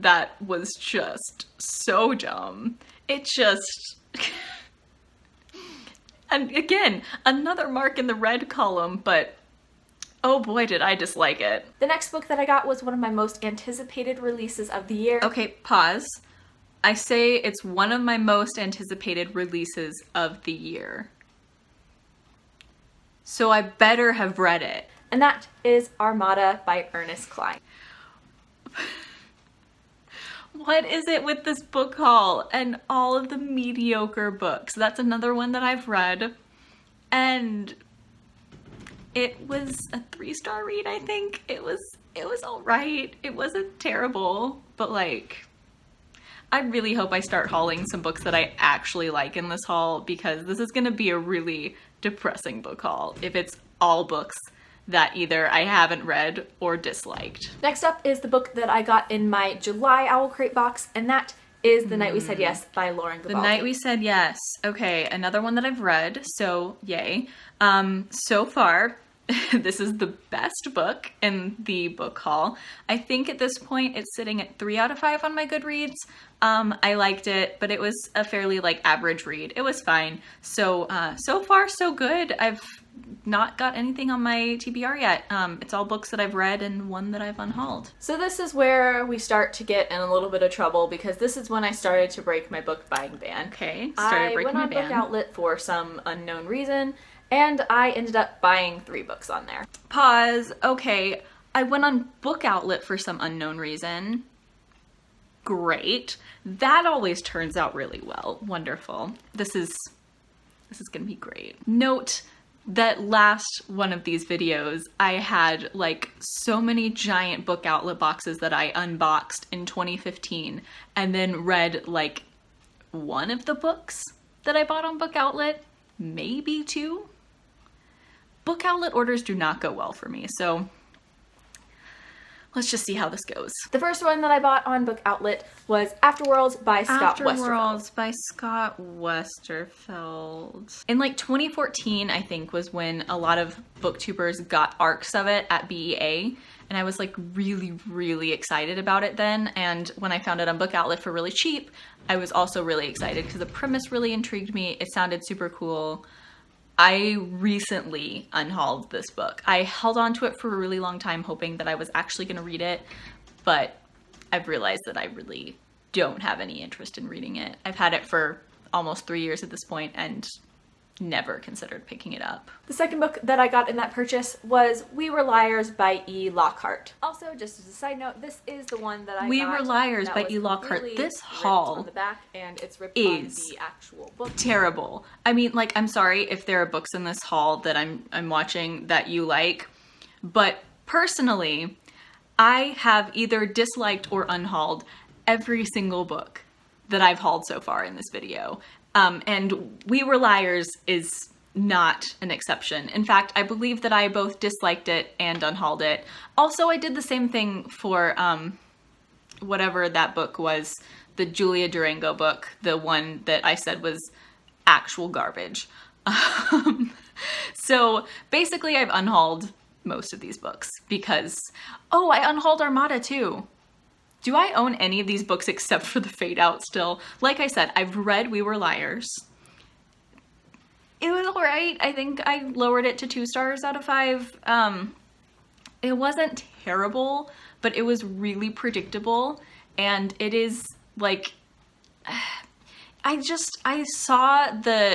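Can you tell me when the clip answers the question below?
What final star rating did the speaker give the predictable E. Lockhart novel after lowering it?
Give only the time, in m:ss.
3:53.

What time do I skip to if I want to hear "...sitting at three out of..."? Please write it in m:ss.
1:14.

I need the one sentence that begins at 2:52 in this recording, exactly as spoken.
The second book that I got in that purchase was We Were Liars by E.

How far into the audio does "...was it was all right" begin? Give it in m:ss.
0:41.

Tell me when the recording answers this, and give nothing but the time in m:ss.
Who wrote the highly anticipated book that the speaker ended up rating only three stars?
0:26.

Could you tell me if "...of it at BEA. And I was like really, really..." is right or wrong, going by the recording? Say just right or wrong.
right.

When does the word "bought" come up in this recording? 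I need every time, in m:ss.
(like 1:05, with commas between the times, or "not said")
2:04, 2:14.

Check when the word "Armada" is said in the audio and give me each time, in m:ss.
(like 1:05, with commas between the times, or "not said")
0:25, 3:42.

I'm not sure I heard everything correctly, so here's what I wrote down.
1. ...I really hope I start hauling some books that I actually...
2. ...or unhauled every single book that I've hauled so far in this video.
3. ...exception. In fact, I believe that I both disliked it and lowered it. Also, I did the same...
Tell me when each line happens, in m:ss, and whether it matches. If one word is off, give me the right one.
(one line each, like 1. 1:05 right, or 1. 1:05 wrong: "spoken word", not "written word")
1. 0:46 right
2. 3:14 right
3. 3:22 wrong: "unhauled", not "lowered".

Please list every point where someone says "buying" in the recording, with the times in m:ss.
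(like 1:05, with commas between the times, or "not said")
1:32, 1:38.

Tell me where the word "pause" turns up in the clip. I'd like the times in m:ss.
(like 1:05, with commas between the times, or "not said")
0:15, 1:39.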